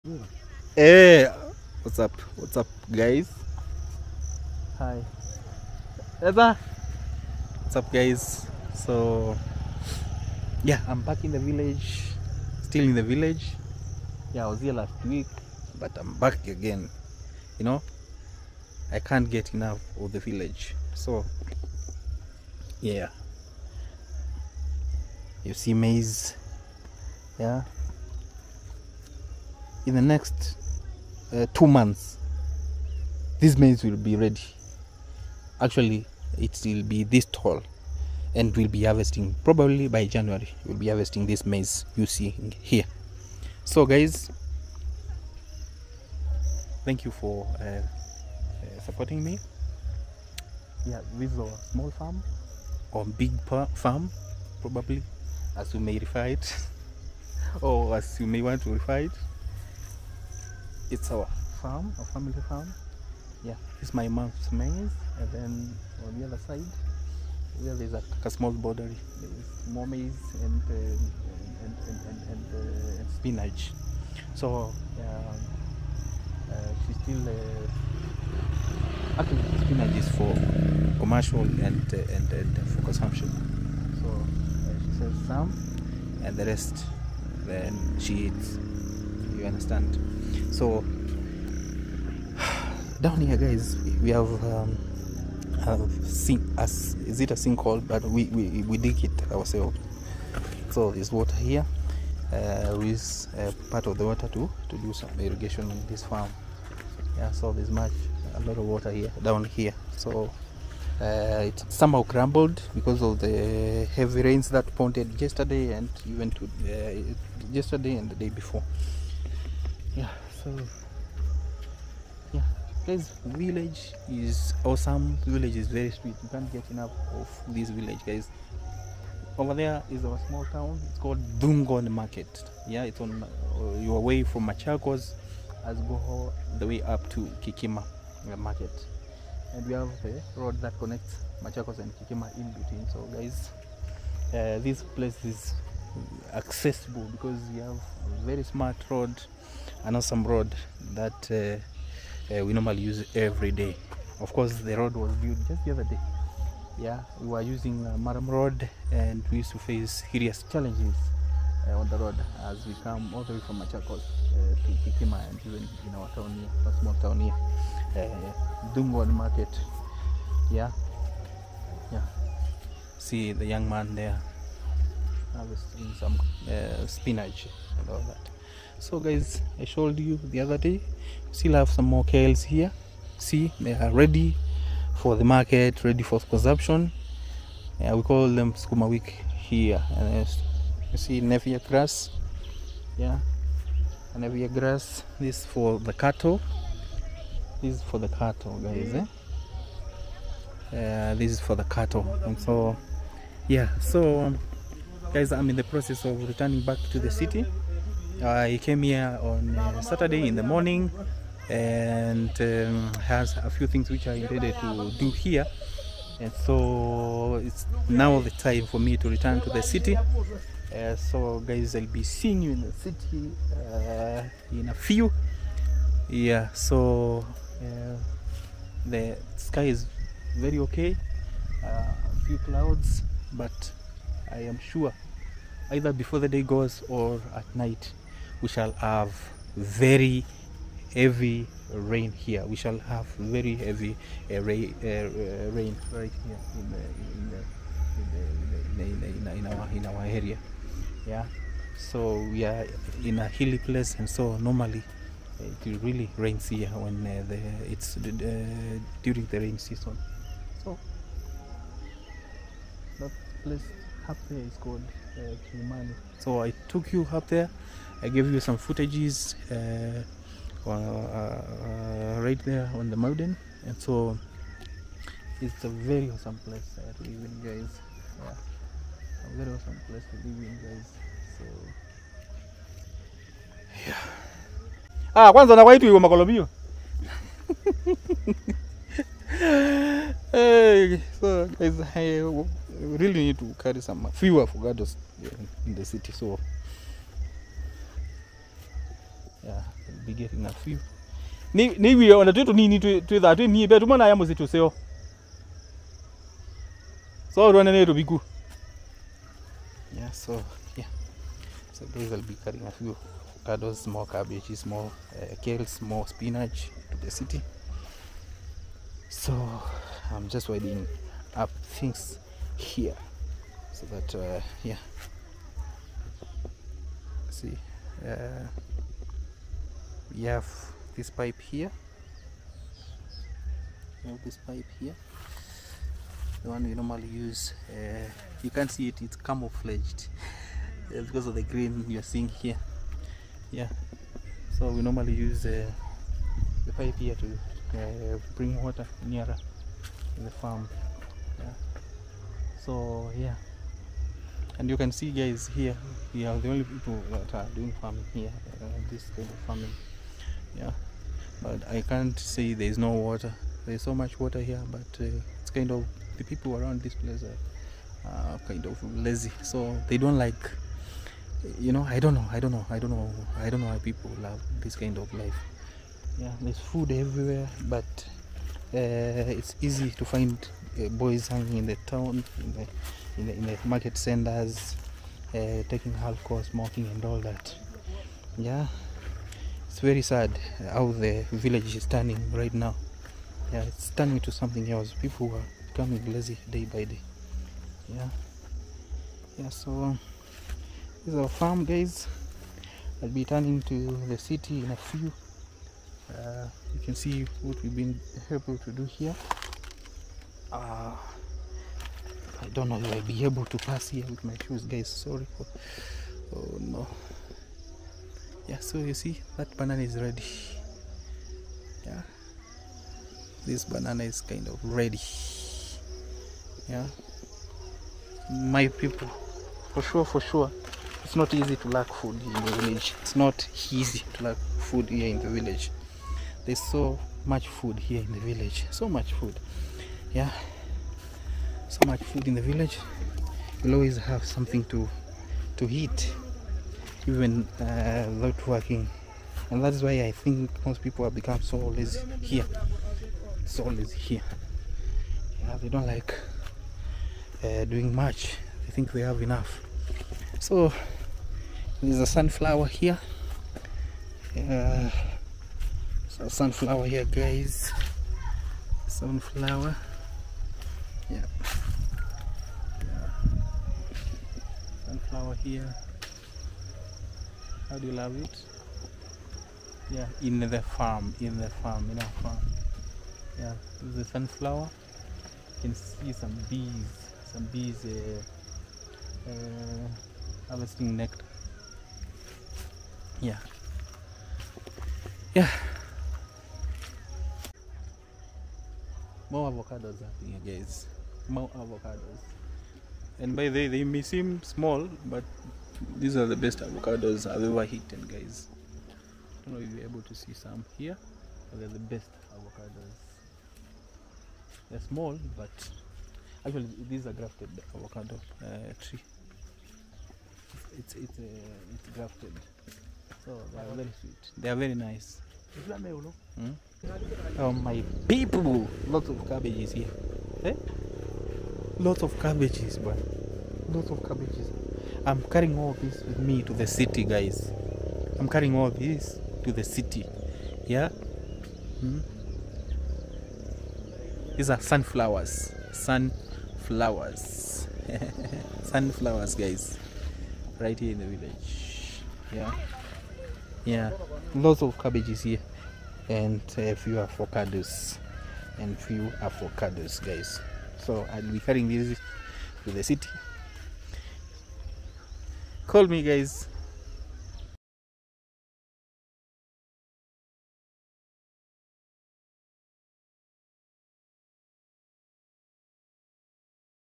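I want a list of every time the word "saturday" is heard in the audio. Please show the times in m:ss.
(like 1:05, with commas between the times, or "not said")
3:29.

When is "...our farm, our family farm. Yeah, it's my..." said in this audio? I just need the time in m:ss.
1:01.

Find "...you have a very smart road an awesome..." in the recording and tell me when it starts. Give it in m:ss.
2:27.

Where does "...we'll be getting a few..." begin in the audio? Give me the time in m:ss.
4:59.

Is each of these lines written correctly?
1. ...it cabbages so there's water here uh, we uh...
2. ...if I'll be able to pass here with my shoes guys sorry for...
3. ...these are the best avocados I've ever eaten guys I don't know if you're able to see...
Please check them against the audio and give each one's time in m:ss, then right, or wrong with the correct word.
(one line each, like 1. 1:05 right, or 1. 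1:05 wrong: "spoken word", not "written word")
1. 1:39 wrong: "ourselves", not "cabbages"
2. 6:52 right
3. 8:26 right.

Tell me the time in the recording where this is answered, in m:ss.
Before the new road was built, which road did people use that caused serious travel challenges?
2:37.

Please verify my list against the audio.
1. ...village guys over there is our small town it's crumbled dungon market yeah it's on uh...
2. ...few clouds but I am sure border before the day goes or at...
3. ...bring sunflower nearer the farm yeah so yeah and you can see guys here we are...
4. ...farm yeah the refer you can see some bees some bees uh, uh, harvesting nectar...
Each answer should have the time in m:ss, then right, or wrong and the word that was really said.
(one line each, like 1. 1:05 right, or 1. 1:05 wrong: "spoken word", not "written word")
1. 2:07 wrong: "called", not "crumbled"
2. 3:52 wrong: "either", not "border"
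3. 5:48 wrong: "water", not "sunflower"
4. 8:02 wrong: "sunflower", not "refer".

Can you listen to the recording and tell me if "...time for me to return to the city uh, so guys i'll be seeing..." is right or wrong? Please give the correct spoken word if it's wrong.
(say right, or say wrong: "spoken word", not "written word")
right.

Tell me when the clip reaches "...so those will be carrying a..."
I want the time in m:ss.
5:11.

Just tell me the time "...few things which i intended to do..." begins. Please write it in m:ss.
3:33.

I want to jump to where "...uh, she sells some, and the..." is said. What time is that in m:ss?
1:24.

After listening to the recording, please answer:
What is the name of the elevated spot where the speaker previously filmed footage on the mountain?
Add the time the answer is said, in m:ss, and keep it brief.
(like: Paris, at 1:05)
Kilimani, at 4:25.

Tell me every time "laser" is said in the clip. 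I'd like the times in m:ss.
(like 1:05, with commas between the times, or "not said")
not said.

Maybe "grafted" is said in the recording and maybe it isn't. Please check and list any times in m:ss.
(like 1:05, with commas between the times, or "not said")
8:37, 8:41.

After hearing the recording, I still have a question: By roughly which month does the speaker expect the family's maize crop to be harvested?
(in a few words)
January.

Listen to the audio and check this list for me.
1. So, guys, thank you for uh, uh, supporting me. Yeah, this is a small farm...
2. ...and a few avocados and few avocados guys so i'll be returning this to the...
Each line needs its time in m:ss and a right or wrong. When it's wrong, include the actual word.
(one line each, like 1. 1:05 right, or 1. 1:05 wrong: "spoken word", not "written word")
1. 0:43 right
2. 9:16 wrong: "carrying", not "returning".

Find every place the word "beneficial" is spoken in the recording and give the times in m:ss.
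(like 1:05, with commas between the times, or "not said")
not said.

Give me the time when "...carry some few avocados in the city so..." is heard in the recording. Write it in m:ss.
4:53.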